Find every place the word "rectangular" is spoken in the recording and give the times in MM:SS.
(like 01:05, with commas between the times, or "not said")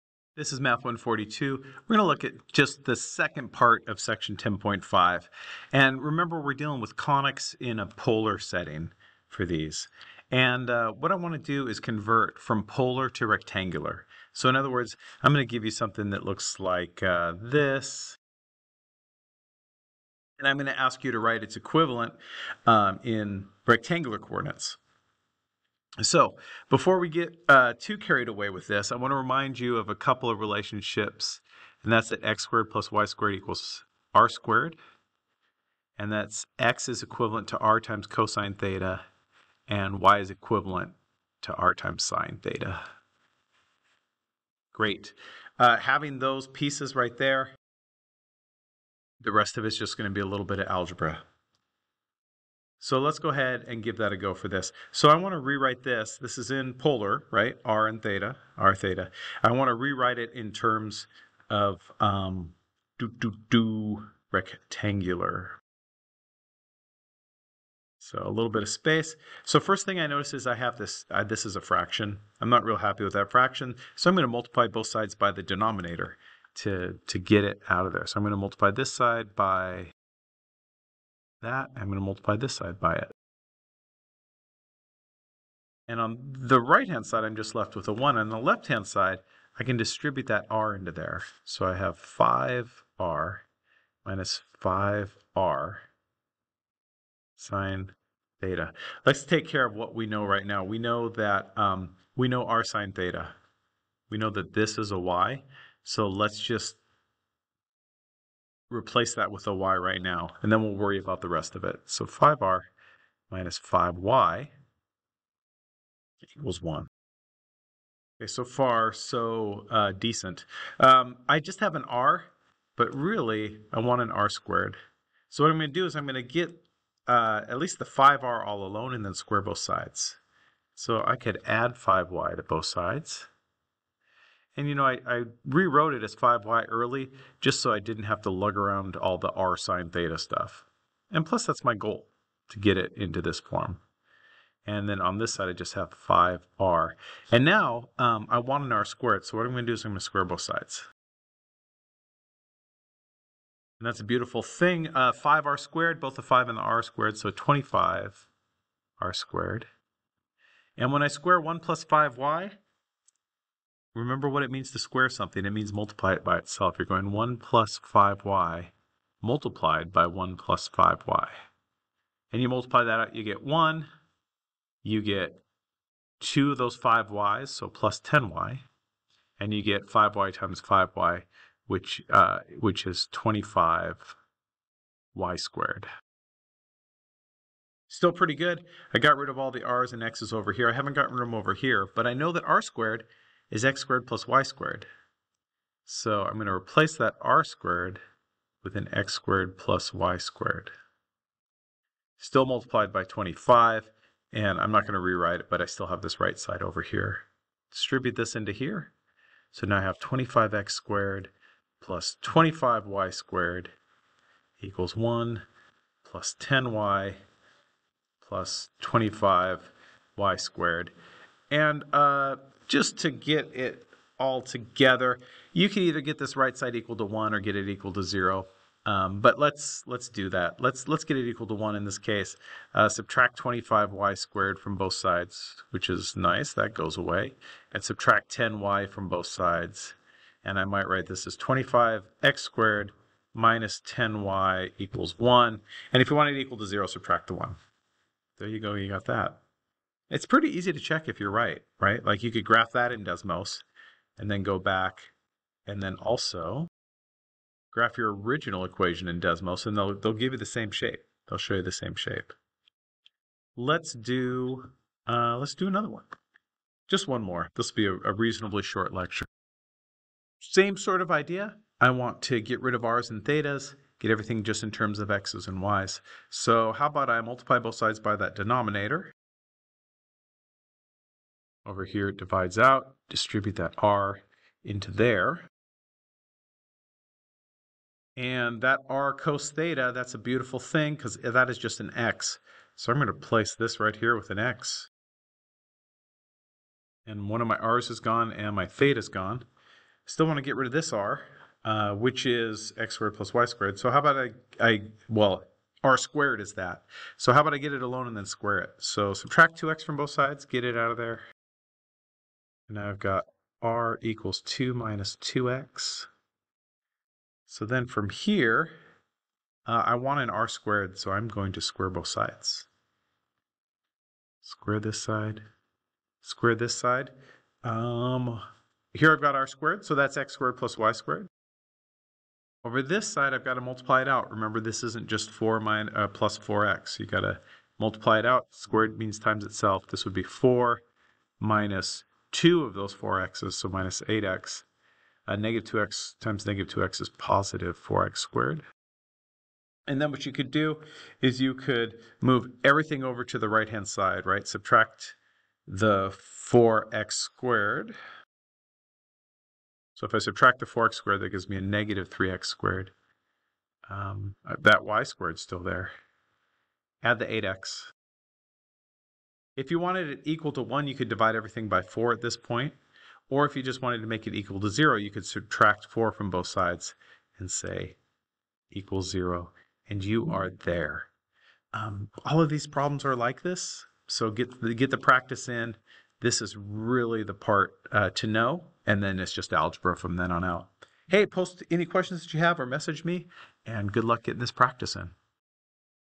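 00:13, 00:23, 01:04.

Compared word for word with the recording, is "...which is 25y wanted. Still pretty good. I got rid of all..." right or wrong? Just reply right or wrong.
wrong.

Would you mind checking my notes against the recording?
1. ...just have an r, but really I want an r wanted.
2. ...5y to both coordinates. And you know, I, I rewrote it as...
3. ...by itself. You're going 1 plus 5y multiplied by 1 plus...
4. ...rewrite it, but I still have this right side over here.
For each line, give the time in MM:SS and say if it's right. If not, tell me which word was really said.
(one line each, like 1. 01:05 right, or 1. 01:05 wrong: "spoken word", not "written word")
1. 02:01 wrong: "squared", not "wanted"
2. 02:11 wrong: "sides", not "coordinates"
3. 02:46 right
4. 03:24 right.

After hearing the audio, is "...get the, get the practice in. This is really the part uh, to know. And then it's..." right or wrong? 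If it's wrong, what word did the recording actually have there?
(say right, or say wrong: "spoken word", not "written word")
right.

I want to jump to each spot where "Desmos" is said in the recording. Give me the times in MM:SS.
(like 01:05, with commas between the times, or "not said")
04:13, 04:19.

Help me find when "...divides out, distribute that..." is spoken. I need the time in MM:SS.
04:42.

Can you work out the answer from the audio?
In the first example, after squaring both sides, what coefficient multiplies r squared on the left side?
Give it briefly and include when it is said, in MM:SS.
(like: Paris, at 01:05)
25, at 02:37.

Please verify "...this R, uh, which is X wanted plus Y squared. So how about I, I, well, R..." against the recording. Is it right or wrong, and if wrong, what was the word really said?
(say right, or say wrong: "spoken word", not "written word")
wrong: "squared", not "wanted".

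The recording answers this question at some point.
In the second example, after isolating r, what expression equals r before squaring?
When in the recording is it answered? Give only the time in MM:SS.
05:14.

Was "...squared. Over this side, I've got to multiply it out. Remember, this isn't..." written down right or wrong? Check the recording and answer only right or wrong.
right.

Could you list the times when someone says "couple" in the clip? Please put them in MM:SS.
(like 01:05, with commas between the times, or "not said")
00:29.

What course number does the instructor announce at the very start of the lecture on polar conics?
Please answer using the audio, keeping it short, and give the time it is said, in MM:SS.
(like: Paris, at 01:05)
Math 142, at 00:00.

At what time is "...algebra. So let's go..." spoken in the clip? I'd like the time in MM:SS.
00:50.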